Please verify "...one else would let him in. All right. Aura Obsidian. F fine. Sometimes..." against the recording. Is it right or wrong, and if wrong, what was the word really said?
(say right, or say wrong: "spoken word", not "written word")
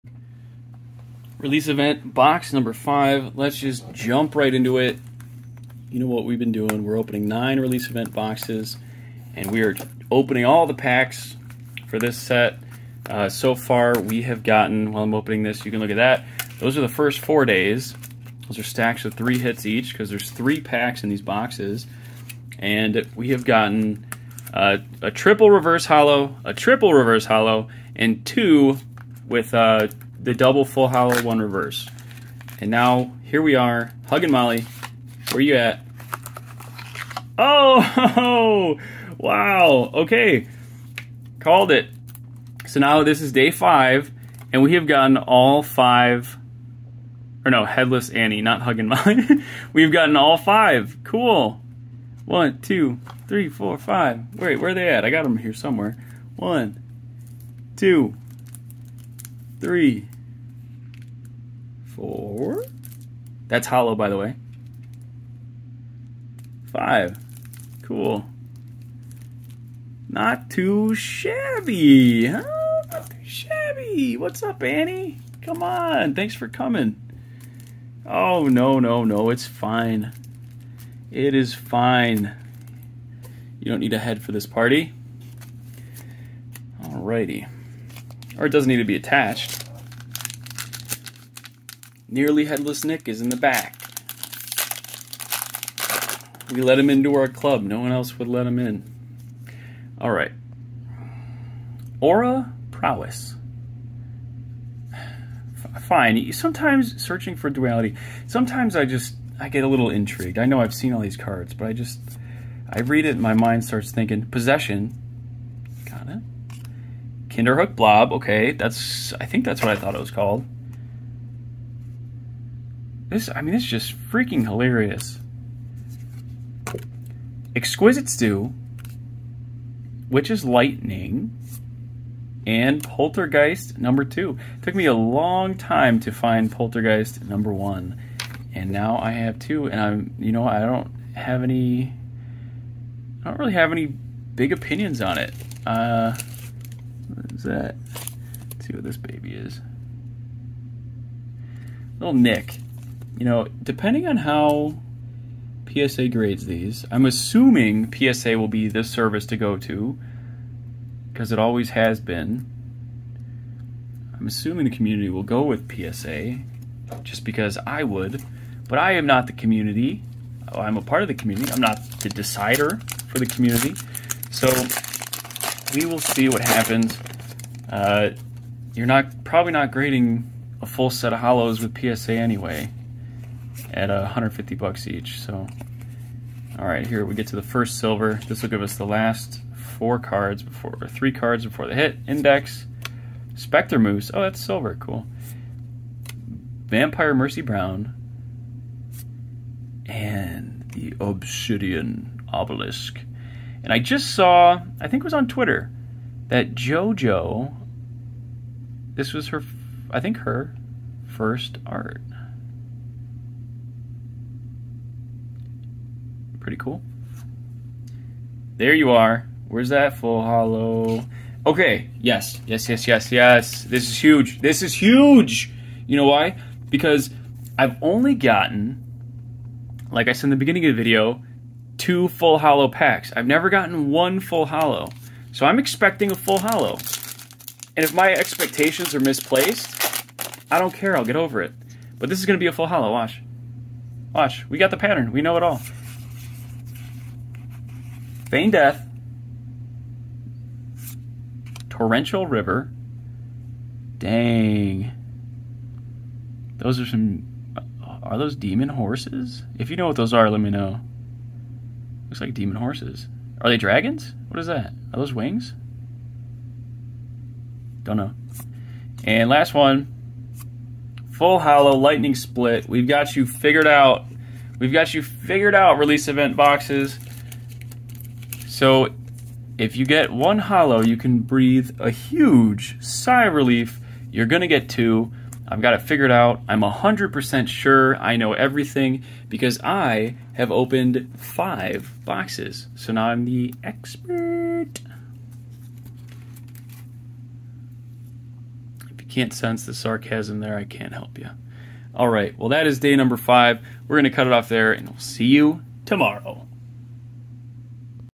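wrong: "Prowess", not "Obsidian".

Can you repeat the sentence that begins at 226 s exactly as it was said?
Because I've only gotten, like I said in the beginning of the video, two full hollow packs.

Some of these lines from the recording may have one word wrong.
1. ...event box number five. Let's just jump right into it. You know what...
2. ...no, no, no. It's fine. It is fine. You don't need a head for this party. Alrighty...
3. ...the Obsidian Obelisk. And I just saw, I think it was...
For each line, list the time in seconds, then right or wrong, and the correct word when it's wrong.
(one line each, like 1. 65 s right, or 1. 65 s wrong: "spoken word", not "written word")
1. 1 s right
2. 78 s right
3. 200 s right.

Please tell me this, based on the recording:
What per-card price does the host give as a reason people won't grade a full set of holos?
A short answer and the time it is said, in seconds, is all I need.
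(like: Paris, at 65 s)
$150, at 184 s.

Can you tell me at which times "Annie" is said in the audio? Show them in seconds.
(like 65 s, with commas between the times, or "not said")
48 s, 74 s.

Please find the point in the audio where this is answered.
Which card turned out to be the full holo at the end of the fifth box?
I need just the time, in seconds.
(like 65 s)
271 s.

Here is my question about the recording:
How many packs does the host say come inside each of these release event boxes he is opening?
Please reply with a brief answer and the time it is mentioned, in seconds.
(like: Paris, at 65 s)
3, at 20 s.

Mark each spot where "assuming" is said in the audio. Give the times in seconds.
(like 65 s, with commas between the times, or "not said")
157 s, 164 s.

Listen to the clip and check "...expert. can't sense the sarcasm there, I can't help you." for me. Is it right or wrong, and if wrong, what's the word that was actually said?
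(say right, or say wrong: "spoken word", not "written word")
right.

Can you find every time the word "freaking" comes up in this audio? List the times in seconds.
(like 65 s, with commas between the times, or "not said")
123 s.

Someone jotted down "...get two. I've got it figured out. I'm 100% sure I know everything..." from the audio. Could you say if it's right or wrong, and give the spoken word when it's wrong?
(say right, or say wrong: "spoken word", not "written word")
right.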